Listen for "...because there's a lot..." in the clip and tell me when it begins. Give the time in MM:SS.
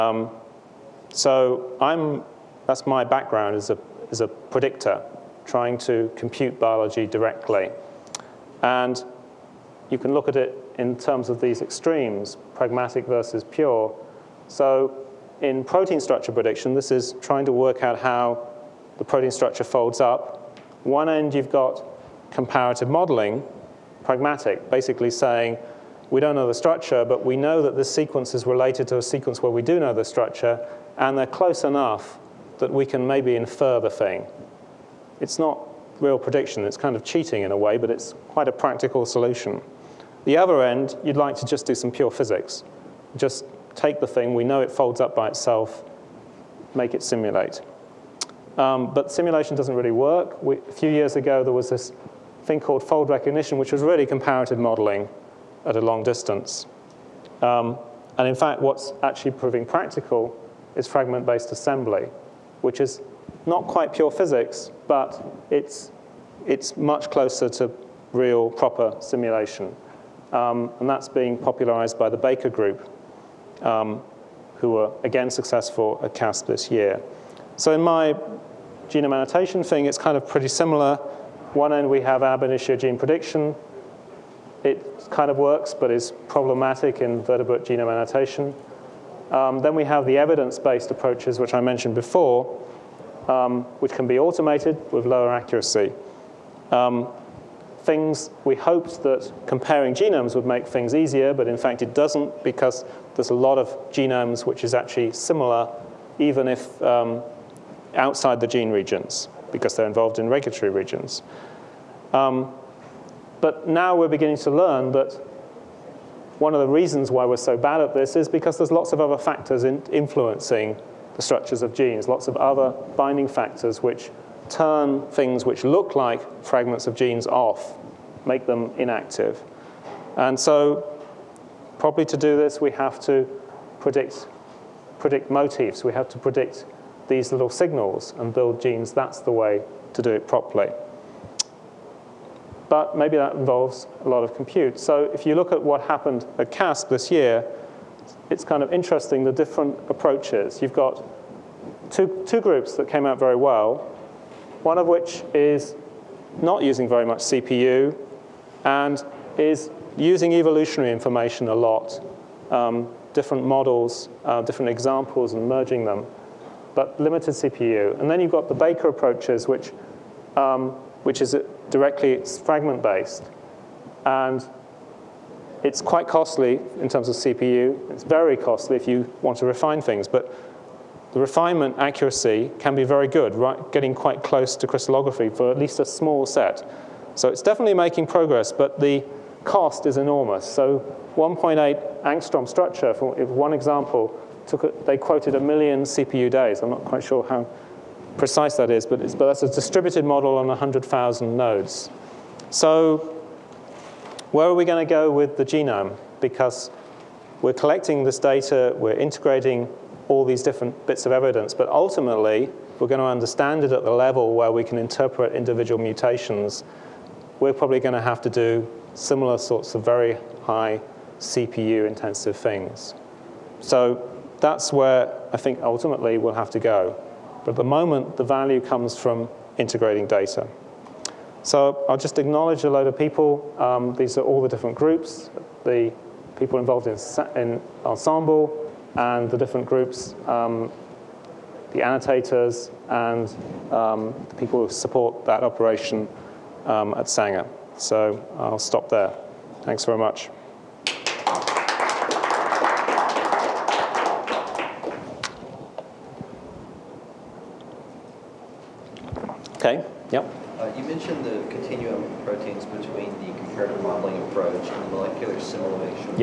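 01:42.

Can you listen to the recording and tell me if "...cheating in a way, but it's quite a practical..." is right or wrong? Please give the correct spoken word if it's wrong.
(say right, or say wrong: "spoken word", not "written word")
right.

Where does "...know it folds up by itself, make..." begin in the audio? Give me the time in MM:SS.
00:44.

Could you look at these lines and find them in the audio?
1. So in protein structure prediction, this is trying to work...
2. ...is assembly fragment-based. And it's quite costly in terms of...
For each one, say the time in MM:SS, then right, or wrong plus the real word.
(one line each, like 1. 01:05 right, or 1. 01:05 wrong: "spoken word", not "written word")
1. 00:14 right
2. 02:51 wrong: "directly", not "assembly".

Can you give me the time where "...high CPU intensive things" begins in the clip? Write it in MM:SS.
03:40.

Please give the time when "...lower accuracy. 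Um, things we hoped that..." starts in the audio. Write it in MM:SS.
01:35.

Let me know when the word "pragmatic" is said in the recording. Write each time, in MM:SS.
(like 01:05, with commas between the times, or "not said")
00:12, 00:24.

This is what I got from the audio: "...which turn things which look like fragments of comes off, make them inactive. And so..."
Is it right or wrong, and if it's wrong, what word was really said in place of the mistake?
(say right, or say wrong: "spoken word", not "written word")
wrong: "genes", not "comes".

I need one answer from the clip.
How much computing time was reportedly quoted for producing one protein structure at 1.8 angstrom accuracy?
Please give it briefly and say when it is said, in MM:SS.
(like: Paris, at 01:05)
1 million CPU days, at 03:15.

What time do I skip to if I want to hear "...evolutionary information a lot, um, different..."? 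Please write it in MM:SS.
02:40.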